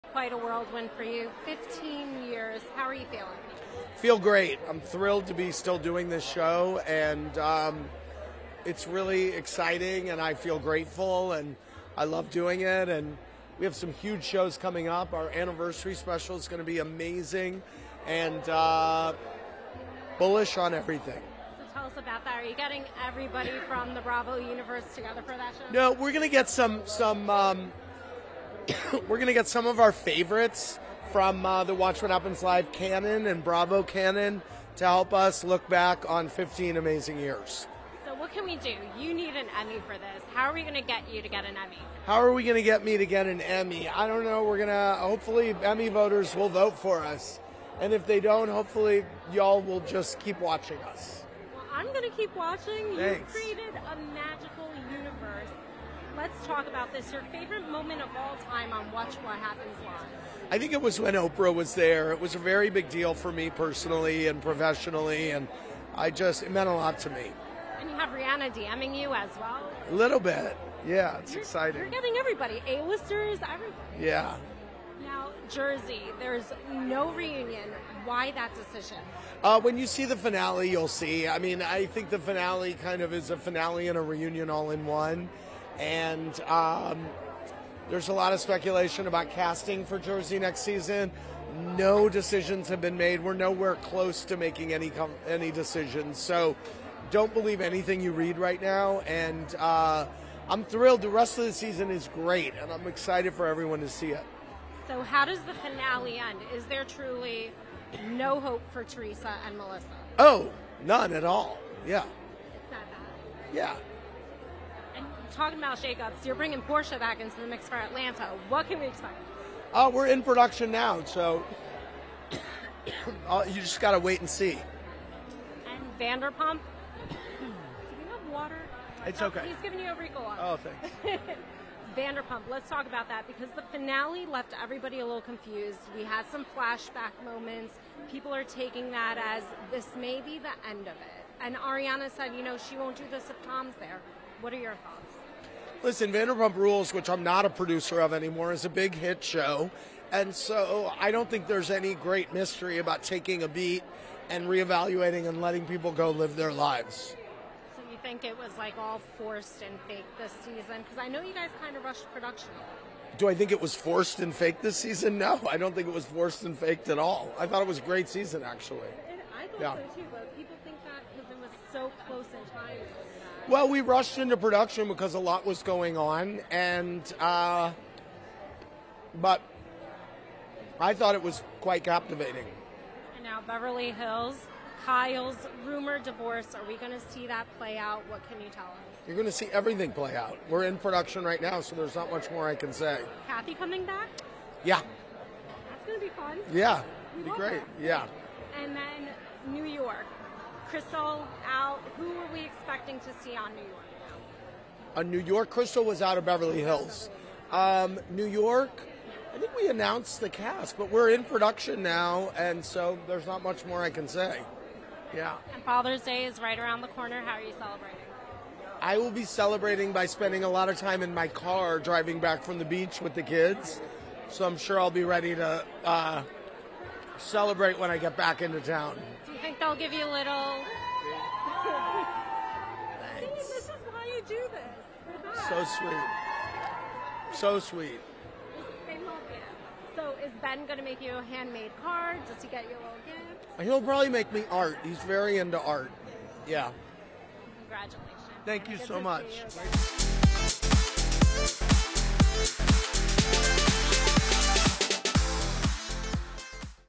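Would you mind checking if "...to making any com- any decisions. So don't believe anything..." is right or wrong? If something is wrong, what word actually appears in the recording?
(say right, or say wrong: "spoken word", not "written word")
right.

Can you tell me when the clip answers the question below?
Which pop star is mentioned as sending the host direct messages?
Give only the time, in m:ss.
1:08.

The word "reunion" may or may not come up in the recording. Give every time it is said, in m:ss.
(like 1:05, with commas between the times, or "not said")
1:17, 1:24.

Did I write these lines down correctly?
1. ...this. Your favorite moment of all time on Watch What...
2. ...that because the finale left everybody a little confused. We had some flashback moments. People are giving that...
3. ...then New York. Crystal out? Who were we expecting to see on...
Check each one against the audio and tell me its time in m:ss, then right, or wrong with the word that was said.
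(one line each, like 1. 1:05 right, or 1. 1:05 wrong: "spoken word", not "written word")
1. 0:56 right
2. 2:13 wrong: "taking", not "giving"
3. 3:18 right.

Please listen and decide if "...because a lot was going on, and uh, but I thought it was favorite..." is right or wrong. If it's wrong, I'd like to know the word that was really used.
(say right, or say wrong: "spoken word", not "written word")
wrong: "quite", not "favorite".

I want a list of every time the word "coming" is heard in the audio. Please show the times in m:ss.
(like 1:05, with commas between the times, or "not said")
0:14, 3:13.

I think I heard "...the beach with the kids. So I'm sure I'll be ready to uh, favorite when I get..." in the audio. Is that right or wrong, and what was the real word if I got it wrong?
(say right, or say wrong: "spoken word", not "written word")
wrong: "celebrate", not "favorite".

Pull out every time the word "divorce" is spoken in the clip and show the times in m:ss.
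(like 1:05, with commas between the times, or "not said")
3:06.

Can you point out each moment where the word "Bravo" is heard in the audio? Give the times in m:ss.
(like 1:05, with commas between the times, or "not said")
0:24, 0:33.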